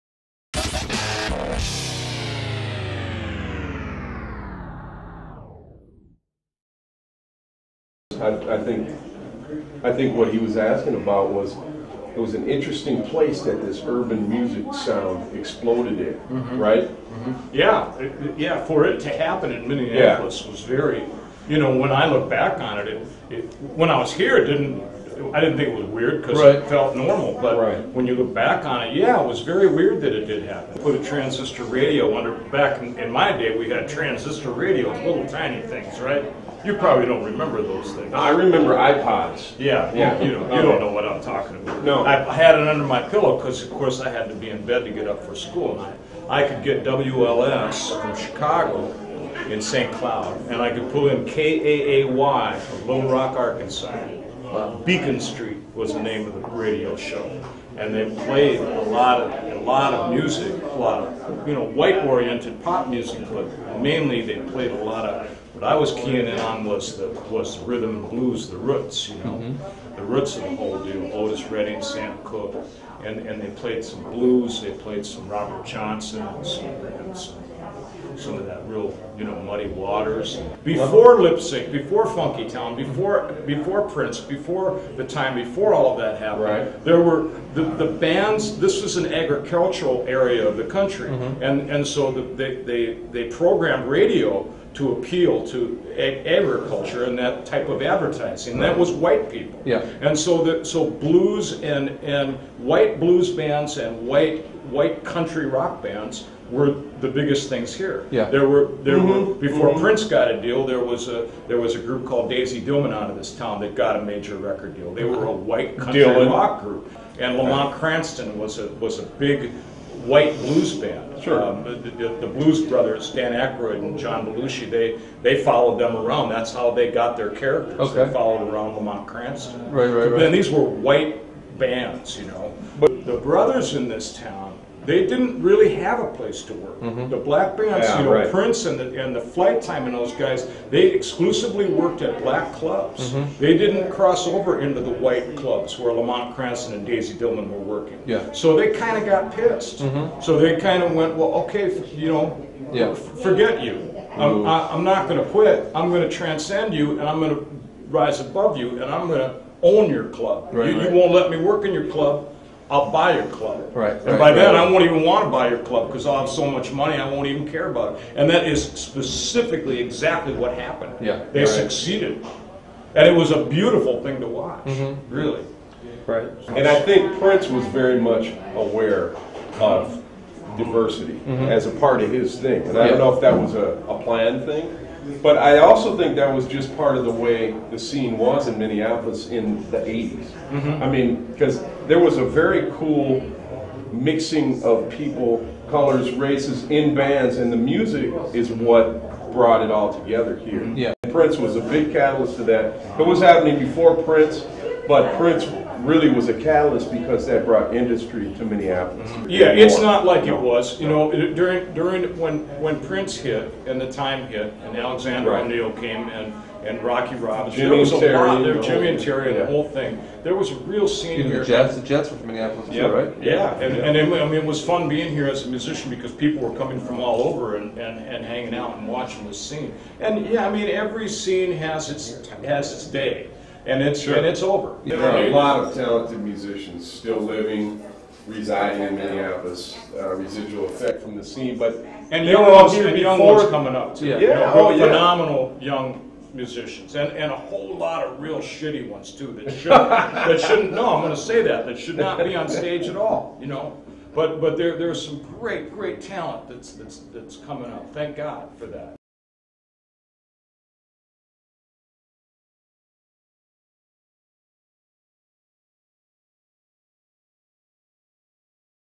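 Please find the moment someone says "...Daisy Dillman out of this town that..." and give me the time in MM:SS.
01:52.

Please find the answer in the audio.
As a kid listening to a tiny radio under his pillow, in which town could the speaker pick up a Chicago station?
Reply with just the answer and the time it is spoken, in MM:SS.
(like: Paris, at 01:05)
St. Cloud, at 00:49.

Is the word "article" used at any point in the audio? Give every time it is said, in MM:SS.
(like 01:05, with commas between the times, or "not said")
not said.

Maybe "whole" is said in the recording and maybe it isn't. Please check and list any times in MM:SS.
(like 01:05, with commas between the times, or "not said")
01:10, 03:39, 04:07.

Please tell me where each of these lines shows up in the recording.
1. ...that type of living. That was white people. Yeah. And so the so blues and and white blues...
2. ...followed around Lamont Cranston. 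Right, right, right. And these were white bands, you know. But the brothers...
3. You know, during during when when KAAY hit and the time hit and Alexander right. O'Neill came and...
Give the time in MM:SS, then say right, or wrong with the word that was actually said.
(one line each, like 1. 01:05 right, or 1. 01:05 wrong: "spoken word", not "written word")
1. 01:37 wrong: "advertising", not "living"
2. 02:08 right
3. 03:30 wrong: "Prince", not "KAAY".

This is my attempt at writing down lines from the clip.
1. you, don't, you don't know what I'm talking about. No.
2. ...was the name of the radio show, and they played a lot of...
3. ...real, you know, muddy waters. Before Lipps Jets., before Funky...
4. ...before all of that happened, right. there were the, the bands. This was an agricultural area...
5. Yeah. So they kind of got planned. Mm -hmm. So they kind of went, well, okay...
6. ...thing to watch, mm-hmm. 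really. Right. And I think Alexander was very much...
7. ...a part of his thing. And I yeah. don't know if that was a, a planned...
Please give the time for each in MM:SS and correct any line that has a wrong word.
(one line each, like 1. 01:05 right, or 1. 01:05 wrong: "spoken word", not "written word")
1. 00:40 right
2. 00:55 right
3. 01:18 wrong: "Inc", not "Jets"
4. 01:25 right
5. 02:28 wrong: "pissed", not "planned"
6. 02:54 wrong: "Prince", not "Alexander"
7. 03:01 right.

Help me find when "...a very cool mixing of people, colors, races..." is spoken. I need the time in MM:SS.
03:12.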